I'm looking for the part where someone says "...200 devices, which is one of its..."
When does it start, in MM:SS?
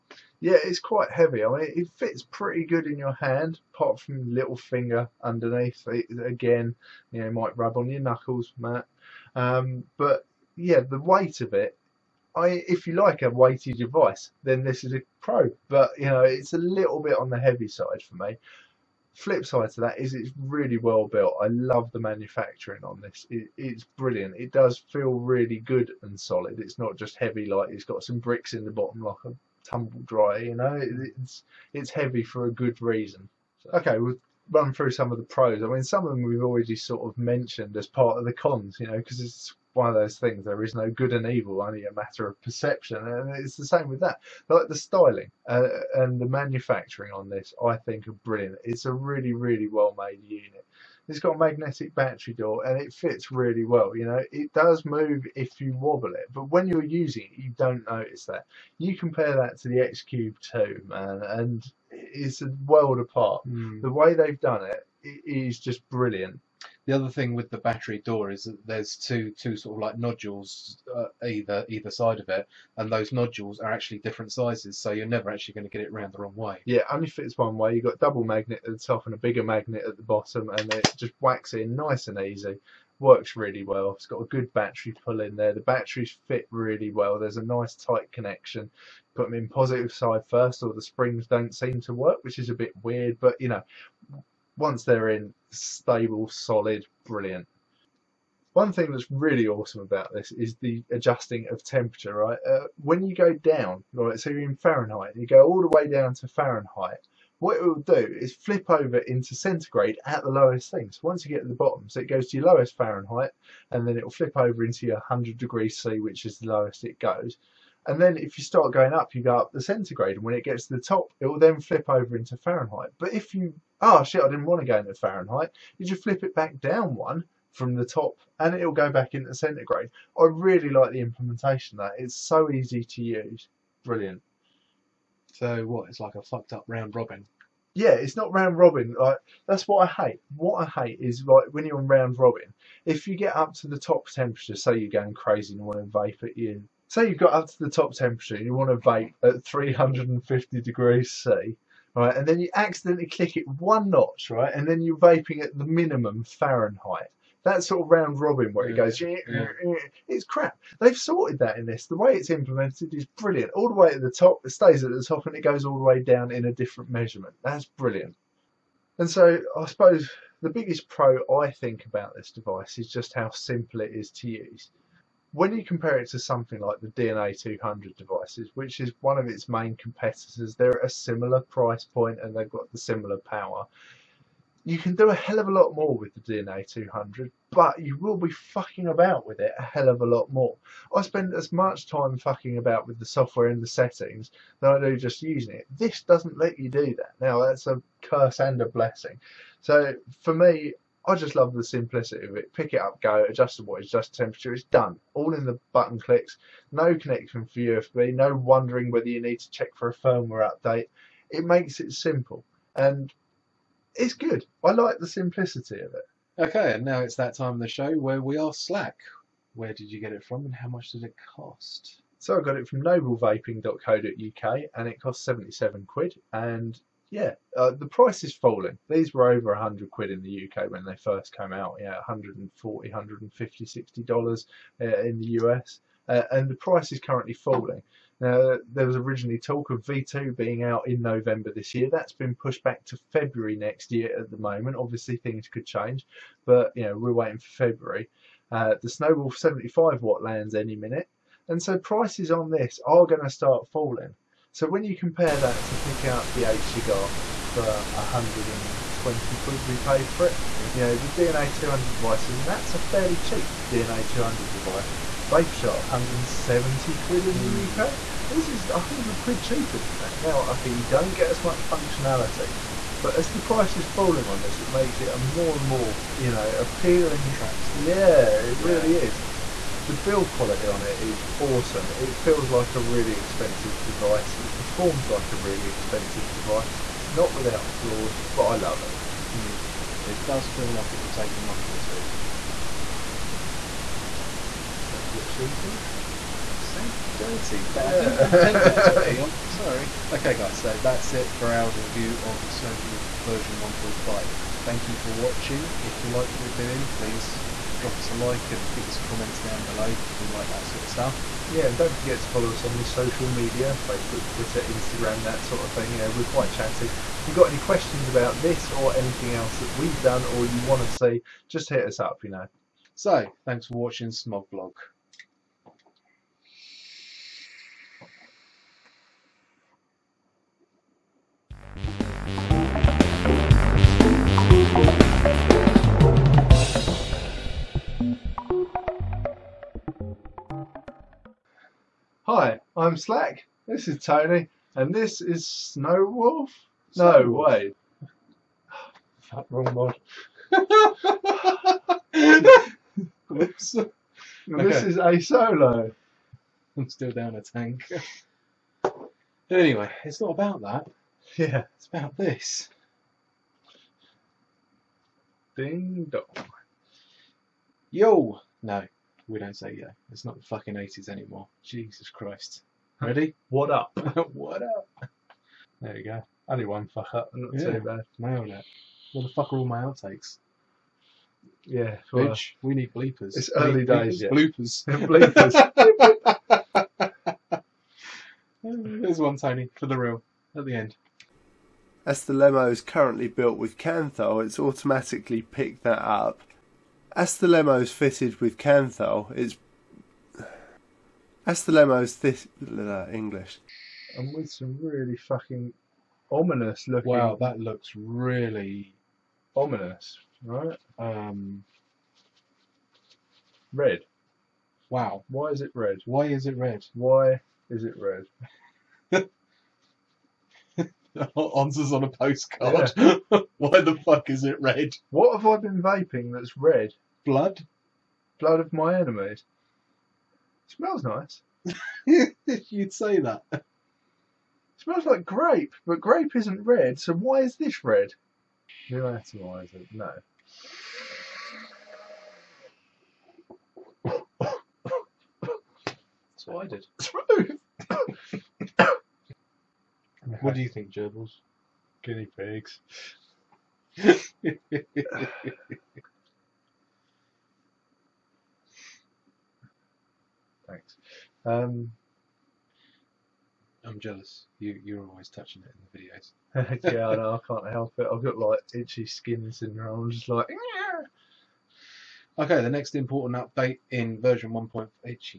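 02:57.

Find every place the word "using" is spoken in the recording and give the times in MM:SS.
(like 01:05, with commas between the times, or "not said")
00:56, 03:15.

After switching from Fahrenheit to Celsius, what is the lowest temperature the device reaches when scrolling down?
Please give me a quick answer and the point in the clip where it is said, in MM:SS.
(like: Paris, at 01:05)
100 degrees C, at 01:54.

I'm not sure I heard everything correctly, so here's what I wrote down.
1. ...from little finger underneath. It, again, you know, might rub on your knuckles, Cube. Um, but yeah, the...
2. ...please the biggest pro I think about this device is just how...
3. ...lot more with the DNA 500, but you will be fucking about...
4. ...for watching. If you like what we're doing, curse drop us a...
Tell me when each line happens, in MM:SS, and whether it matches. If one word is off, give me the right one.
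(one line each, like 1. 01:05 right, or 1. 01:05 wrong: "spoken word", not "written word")
1. 00:04 wrong: "Matt", not "Cube"
2. 02:49 wrong: "suppose", not "please"
3. 03:05 wrong: "200", not "500"
4. 05:04 wrong: "please", not "curse".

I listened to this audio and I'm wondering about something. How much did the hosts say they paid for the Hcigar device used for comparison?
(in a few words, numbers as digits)
120 quid.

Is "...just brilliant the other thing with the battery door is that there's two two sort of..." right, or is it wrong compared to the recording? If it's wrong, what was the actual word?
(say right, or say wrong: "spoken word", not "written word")
right.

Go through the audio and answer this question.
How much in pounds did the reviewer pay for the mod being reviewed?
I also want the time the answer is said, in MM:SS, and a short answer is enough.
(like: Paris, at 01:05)
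77 quid, at 03:45.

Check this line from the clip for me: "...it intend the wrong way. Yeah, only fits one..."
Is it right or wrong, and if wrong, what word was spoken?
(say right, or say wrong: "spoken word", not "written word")
wrong: "round", not "intend".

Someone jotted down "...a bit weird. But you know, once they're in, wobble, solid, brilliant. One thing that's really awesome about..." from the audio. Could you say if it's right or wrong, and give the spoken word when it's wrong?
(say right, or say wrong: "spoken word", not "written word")
wrong: "stable", not "wobble".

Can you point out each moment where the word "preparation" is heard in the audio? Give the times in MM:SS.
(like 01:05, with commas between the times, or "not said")
not said.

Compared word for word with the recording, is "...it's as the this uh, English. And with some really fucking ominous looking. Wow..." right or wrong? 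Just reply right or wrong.
right.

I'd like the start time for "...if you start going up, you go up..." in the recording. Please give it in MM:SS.
01:58.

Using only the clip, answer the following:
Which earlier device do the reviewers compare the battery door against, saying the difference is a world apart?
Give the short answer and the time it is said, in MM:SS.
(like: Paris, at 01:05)
X Cube 2, at 00:59.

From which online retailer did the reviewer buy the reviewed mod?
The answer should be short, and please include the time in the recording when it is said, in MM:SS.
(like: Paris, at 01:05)
noblevaping.co.uk, at 03:42.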